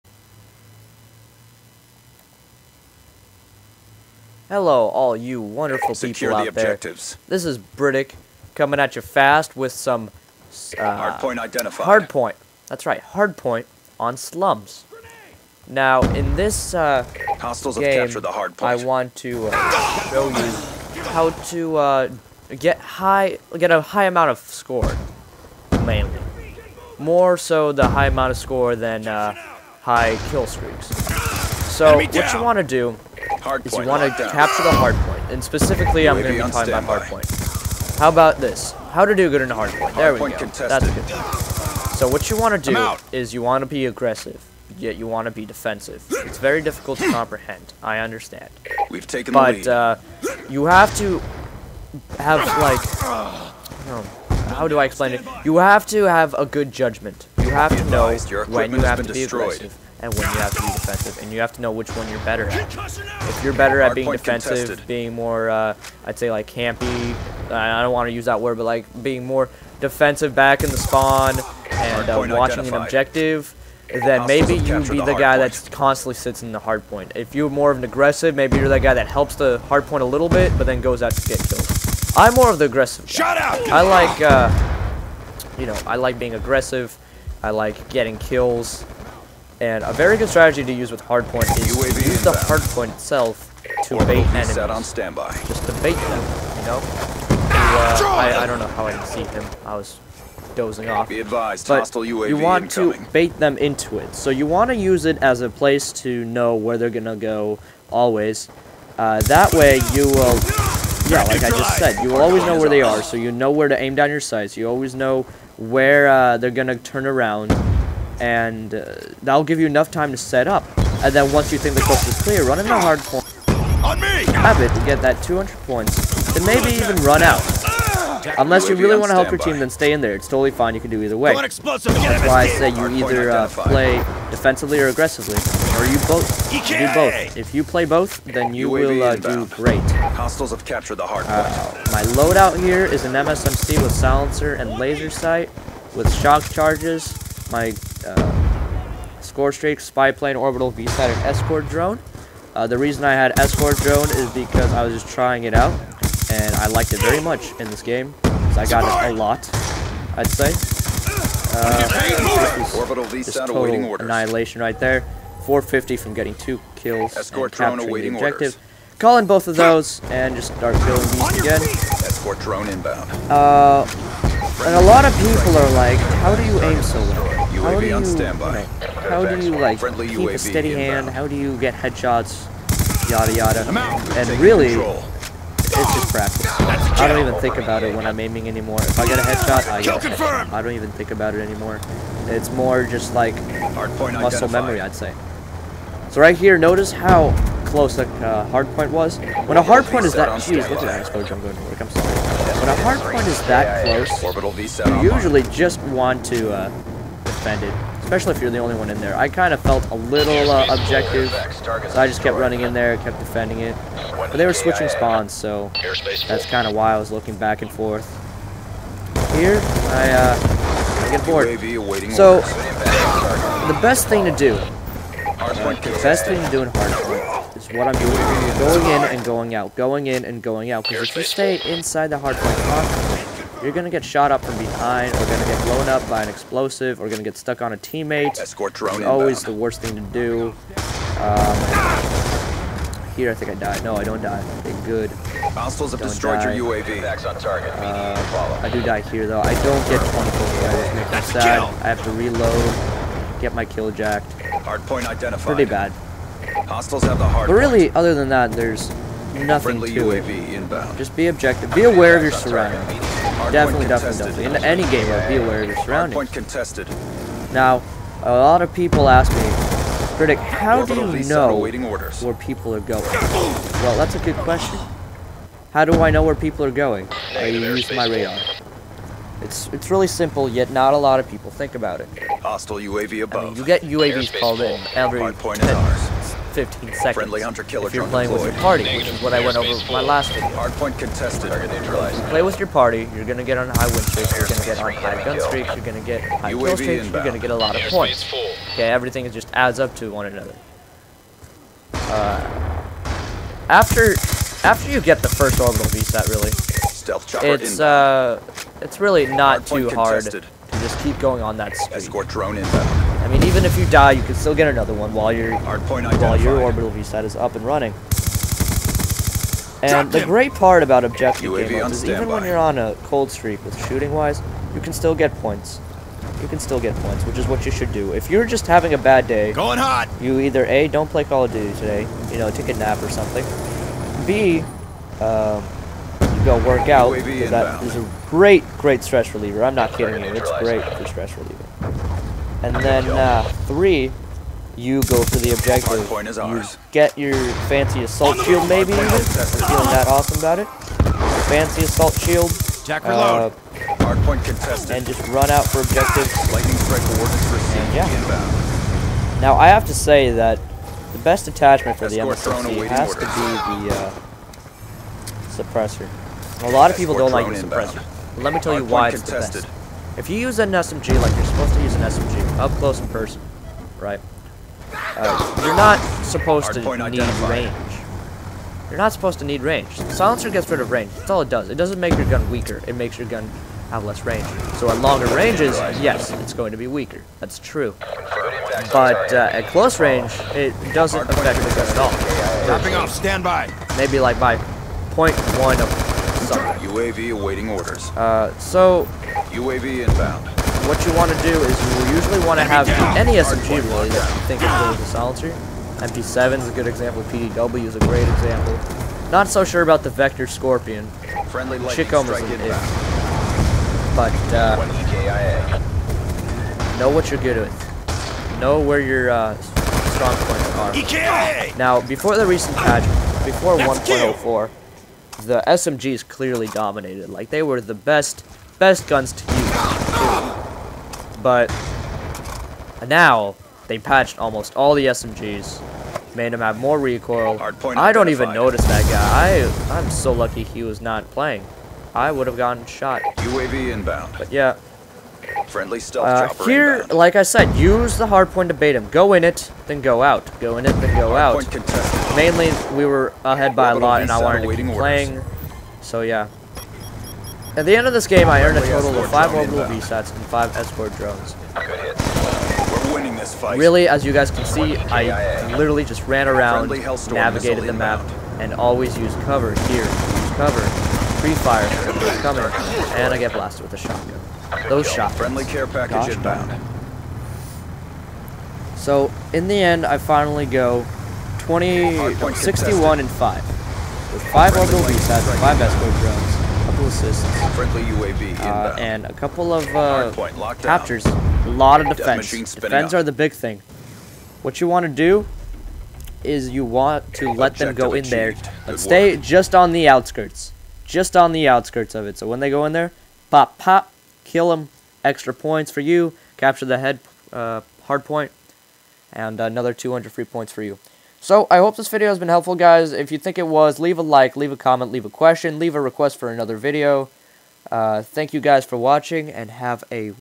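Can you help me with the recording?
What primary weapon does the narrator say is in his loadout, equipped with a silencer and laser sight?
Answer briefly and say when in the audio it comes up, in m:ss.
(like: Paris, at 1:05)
MSMC, at 2:23.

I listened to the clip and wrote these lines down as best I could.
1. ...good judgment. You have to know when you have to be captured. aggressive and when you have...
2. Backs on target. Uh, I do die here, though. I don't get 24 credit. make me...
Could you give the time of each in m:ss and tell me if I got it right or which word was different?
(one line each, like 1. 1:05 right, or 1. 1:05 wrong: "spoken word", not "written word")
1. 0:56 wrong: "destroyed", not "captured"
2. 4:07 right.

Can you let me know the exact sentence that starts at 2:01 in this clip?
And then once you think the coast is clear, run in a hard point.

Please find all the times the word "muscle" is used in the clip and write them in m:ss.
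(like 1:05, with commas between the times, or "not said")
3:13.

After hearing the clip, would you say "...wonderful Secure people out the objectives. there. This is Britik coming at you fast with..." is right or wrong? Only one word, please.
right.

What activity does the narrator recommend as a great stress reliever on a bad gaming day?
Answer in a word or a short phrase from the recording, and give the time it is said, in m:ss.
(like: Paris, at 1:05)
work out, at 5:36.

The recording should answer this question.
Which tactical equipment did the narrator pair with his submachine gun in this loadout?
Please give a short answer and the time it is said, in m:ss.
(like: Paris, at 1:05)
shock charges, at 2:26.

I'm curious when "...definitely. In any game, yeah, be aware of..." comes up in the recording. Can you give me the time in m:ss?
4:24.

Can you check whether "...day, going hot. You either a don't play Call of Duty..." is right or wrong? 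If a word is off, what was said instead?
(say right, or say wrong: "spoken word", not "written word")
right.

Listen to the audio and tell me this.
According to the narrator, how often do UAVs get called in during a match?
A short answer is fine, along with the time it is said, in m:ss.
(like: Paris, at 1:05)
every 10, 15 seconds, at 4:44.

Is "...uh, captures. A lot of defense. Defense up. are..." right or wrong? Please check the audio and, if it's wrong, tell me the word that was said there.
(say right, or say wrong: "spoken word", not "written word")
right.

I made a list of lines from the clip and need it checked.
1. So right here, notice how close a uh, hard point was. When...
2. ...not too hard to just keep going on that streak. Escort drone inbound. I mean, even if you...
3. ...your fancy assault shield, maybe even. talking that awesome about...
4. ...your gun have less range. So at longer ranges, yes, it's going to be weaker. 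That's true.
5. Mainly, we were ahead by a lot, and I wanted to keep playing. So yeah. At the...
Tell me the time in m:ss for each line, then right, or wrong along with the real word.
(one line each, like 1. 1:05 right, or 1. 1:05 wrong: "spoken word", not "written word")
1. 3:16 right
2. 5:09 right
3. 5:47 wrong: "feeling", not "talking"
4. 6:23 right
5. 7:32 right.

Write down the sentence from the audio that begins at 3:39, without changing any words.
Here, I, uh, I get bored.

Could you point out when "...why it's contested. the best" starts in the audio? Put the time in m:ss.
6:08.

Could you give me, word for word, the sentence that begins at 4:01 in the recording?
Um, here, I think I died.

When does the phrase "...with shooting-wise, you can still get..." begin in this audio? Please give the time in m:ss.
5:23.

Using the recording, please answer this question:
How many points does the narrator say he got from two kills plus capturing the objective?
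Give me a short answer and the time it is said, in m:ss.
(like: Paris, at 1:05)
450, at 2:45.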